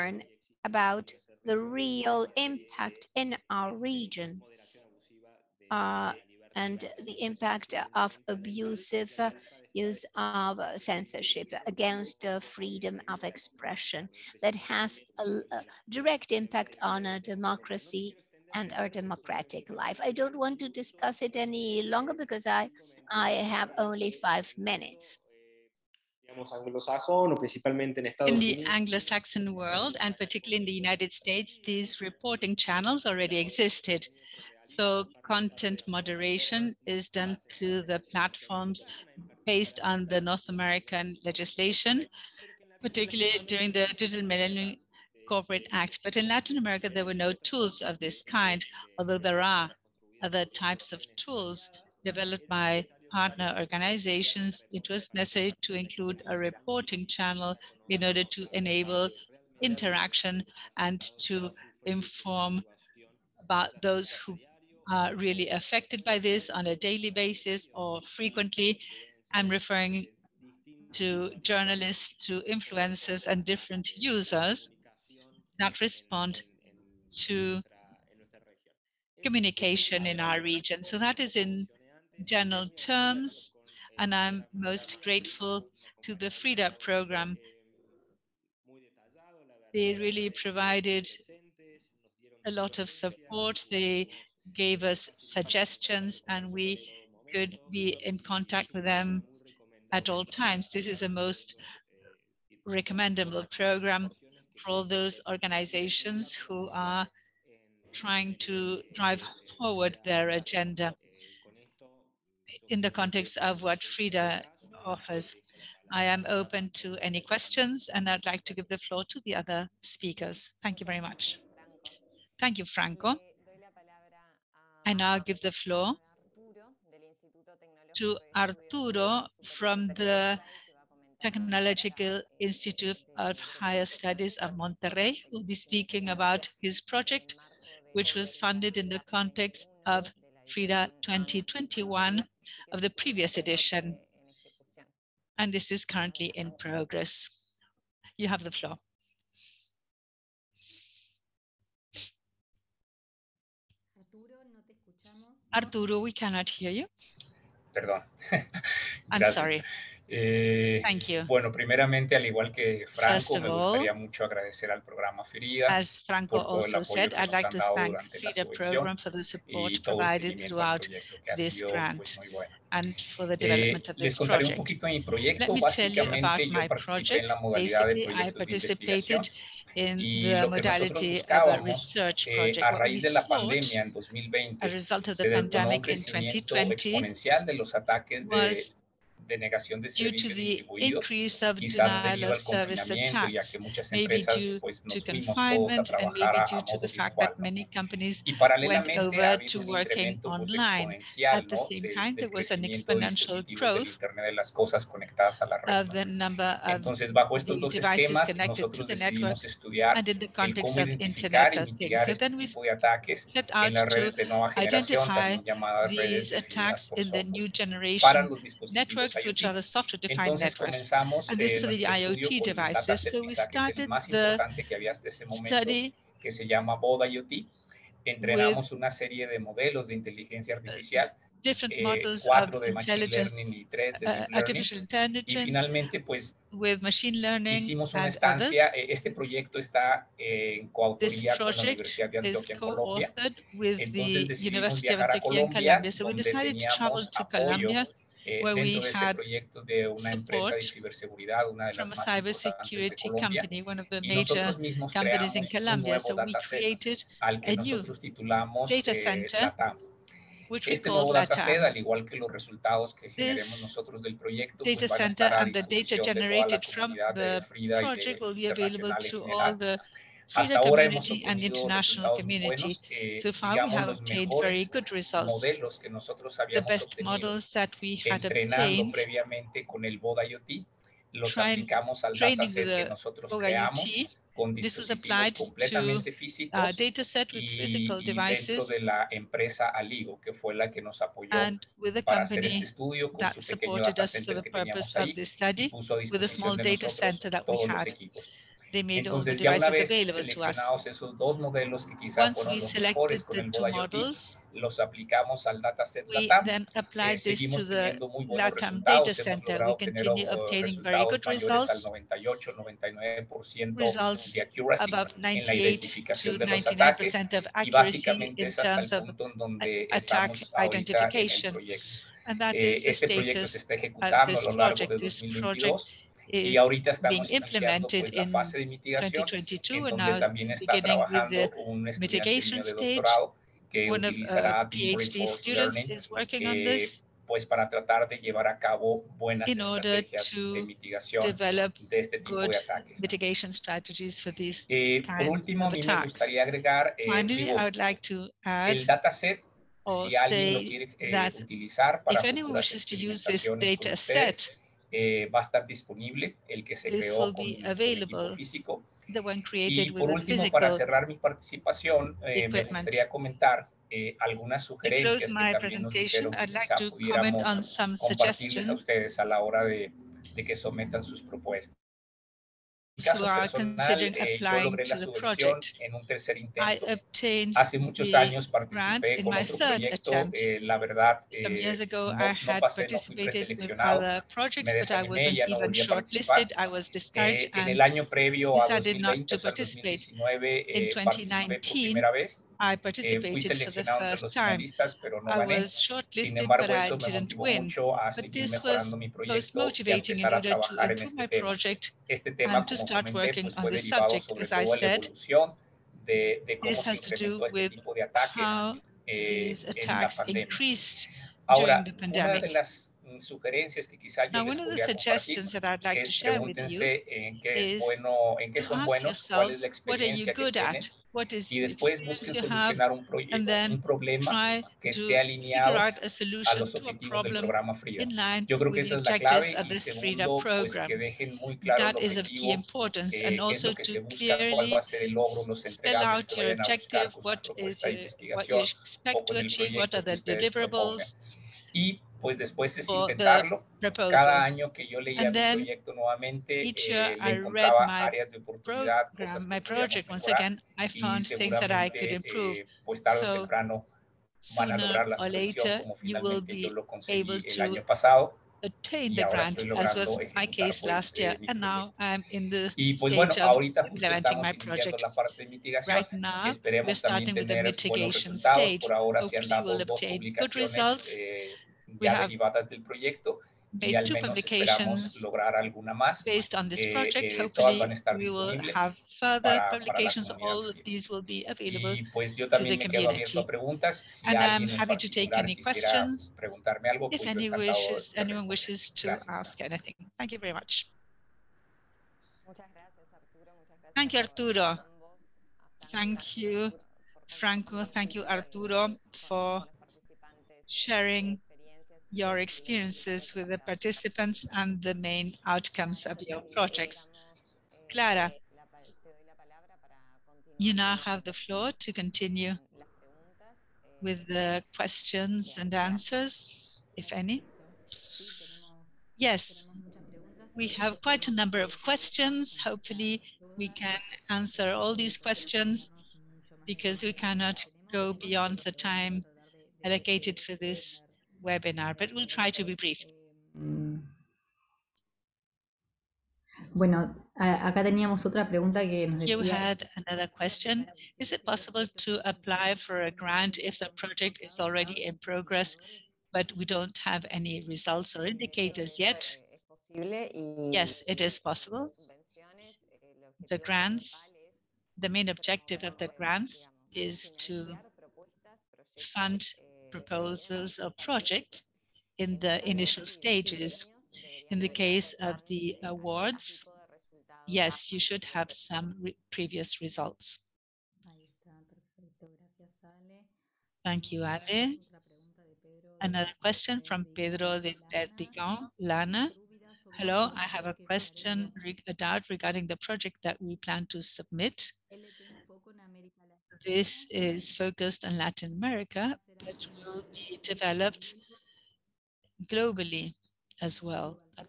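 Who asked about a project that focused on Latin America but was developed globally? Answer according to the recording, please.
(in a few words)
Pedro de Perdigón.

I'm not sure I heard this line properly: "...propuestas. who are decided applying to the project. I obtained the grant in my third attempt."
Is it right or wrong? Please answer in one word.
wrong.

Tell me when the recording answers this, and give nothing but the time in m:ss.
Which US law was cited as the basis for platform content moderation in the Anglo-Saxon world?
0:43.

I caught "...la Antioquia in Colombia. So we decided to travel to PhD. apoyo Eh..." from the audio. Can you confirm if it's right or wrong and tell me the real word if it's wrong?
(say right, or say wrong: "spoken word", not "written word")
wrong: "Colombia", not "PhD".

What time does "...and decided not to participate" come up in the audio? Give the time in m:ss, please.
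6:27.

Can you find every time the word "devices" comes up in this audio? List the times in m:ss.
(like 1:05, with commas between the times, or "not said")
3:27, 3:42, 4:48.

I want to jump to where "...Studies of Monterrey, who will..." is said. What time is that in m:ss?
2:13.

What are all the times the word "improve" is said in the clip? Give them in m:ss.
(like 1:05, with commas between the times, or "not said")
6:40, 7:32.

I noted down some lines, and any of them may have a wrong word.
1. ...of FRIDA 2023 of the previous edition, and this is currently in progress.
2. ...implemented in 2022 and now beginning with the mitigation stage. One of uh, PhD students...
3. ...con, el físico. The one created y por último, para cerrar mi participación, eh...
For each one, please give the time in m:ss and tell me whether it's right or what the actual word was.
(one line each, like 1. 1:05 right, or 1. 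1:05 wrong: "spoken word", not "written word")
1. 2:19 wrong: "2021", not "2023"
2. 5:27 right
3. 5:57 right.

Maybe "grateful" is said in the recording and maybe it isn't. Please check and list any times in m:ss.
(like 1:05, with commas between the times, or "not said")
1:25.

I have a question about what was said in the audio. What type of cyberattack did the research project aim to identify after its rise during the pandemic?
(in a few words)
Denial of service attacks.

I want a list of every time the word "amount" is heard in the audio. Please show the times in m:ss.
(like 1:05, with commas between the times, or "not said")
not said.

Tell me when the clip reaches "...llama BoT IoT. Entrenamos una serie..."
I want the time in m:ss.
3:46.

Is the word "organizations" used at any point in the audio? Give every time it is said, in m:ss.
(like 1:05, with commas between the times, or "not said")
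0:53, 1:45.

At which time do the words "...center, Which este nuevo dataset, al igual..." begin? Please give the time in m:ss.
4:18.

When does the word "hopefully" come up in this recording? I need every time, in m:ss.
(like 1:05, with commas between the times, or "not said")
7:48, 7:57, 8:42.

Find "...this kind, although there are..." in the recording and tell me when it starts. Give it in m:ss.
0:47.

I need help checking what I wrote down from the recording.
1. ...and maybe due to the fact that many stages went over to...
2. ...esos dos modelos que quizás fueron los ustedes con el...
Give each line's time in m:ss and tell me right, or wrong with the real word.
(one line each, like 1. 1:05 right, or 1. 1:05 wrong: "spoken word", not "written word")
1. 3:15 wrong: "companies", not "stages"
2. 5:00 wrong: "mejores", not "ustedes".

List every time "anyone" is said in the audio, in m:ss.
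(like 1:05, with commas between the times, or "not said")
5:52, 8:08.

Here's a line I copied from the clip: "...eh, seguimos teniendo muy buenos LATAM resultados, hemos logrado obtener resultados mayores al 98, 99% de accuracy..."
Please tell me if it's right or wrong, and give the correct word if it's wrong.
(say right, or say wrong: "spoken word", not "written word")
right.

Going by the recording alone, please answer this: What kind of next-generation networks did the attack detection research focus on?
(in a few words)
Software-defined networks.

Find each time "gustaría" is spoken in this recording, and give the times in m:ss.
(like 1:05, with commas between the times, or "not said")
2:43, 6:02.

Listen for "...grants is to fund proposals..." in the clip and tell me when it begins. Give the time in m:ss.
9:16.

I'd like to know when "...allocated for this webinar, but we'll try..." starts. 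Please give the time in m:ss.
8:49.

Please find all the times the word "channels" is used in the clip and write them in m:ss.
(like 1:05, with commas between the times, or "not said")
0:32, 0:57.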